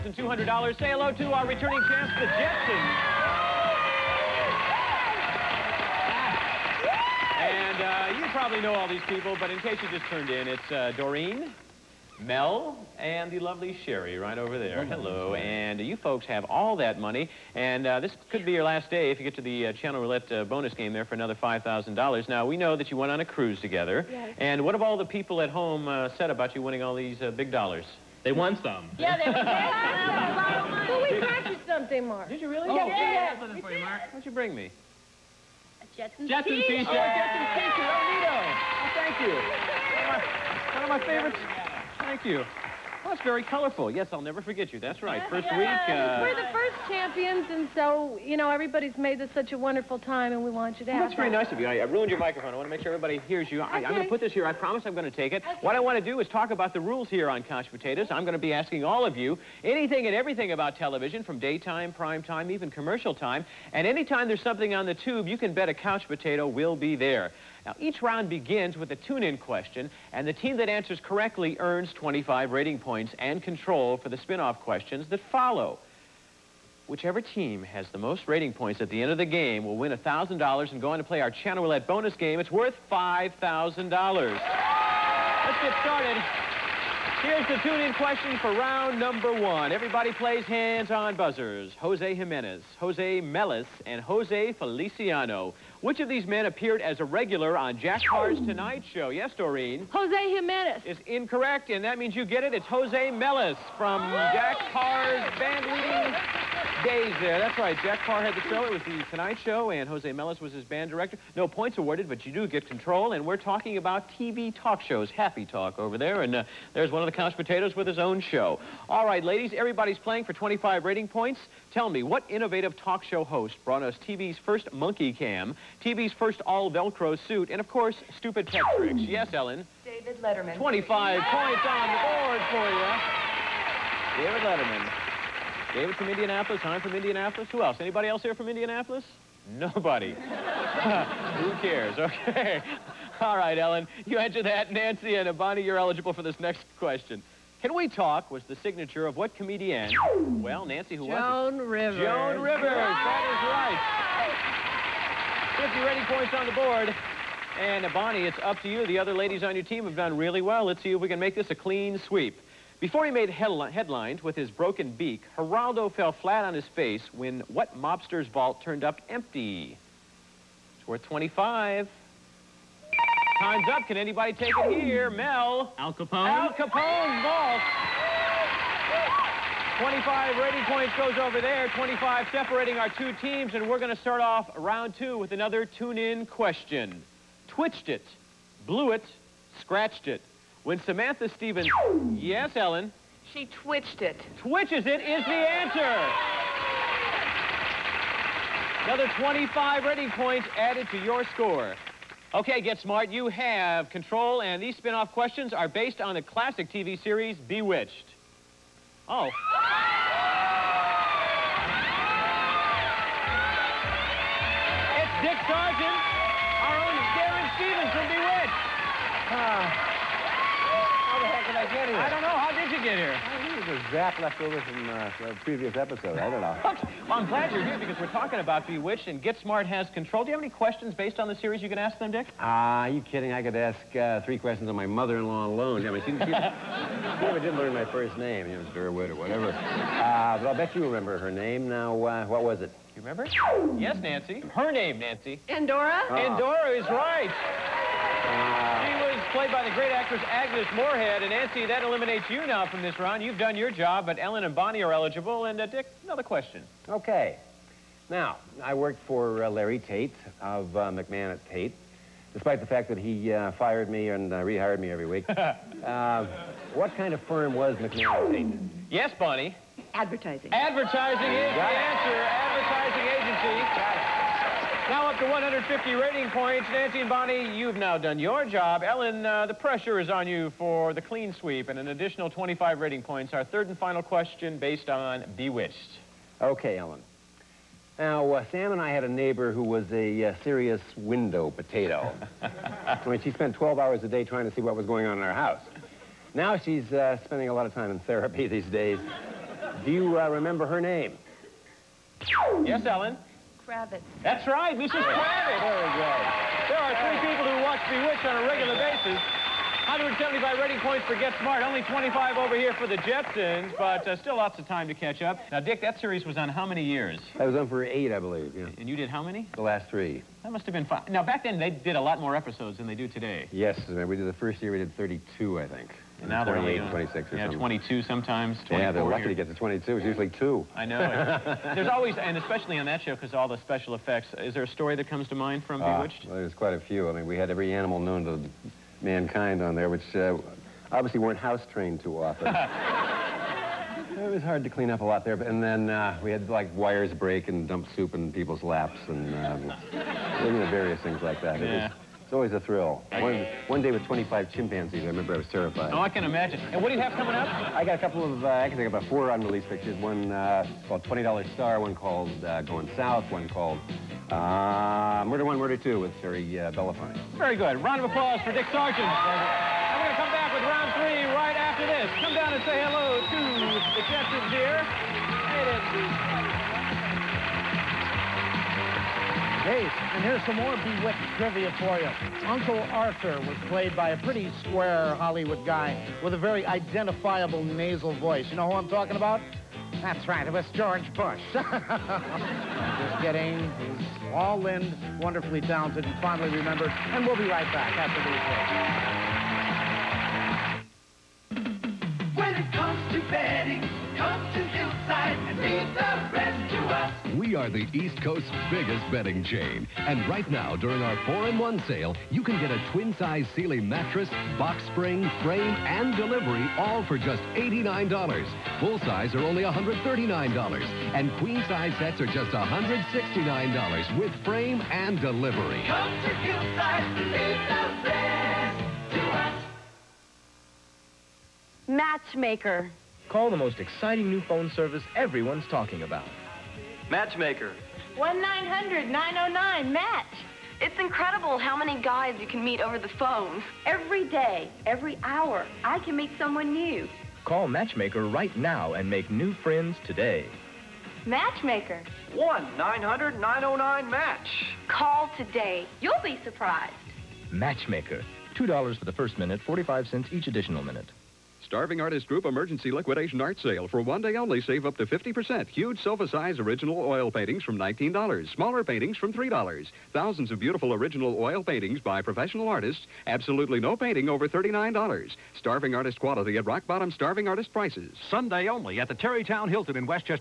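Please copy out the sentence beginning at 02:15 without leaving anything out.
David from Indianapolis, I'm from Indianapolis.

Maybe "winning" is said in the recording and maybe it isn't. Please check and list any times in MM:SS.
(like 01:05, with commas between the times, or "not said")
00:26.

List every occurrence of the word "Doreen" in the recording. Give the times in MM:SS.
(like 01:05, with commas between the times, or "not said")
00:10, 01:39.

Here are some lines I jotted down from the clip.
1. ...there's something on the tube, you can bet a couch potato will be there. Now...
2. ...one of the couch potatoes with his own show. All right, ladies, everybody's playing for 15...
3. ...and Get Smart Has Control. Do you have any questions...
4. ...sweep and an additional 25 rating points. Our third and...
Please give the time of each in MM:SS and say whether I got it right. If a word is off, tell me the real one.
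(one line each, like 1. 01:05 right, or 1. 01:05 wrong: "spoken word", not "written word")
1. 01:04 right
2. 01:56 wrong: "25", not "15"
3. 03:49 right
4. 04:41 right.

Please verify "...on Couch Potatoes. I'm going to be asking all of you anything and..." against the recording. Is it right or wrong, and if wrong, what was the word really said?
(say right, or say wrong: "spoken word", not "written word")
right.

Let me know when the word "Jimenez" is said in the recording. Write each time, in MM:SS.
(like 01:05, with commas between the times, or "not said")
01:32, 01:40.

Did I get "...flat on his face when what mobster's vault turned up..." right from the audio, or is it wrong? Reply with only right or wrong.
right.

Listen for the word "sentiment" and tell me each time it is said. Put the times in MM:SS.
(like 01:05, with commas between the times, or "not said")
not said.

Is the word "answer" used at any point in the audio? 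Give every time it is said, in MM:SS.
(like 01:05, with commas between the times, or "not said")
01:10, 02:24, 03:15, 04:31.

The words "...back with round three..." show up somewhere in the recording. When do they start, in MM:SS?
06:10.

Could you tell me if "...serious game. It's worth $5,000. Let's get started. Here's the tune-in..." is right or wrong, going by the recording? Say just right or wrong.
wrong.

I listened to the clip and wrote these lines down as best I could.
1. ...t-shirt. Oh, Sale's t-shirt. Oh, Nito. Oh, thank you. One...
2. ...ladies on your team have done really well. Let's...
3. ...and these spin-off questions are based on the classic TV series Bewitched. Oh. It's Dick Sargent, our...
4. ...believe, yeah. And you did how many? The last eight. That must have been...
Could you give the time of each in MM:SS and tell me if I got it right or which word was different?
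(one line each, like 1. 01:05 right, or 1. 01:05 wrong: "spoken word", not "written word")
1. 00:36 wrong: "Jetson", not "Sale"
2. 02:39 right
3. 03:24 right
4. 05:18 wrong: "three", not "eight".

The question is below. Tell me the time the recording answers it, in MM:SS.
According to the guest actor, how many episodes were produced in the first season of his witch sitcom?
05:24.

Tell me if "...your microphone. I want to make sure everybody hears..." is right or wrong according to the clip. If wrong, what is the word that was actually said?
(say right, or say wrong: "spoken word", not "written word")
right.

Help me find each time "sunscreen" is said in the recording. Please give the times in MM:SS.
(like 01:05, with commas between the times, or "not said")
not said.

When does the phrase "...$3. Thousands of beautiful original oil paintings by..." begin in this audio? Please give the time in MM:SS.
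07:49.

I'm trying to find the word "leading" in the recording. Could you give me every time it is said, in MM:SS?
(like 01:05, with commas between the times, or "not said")
01:45.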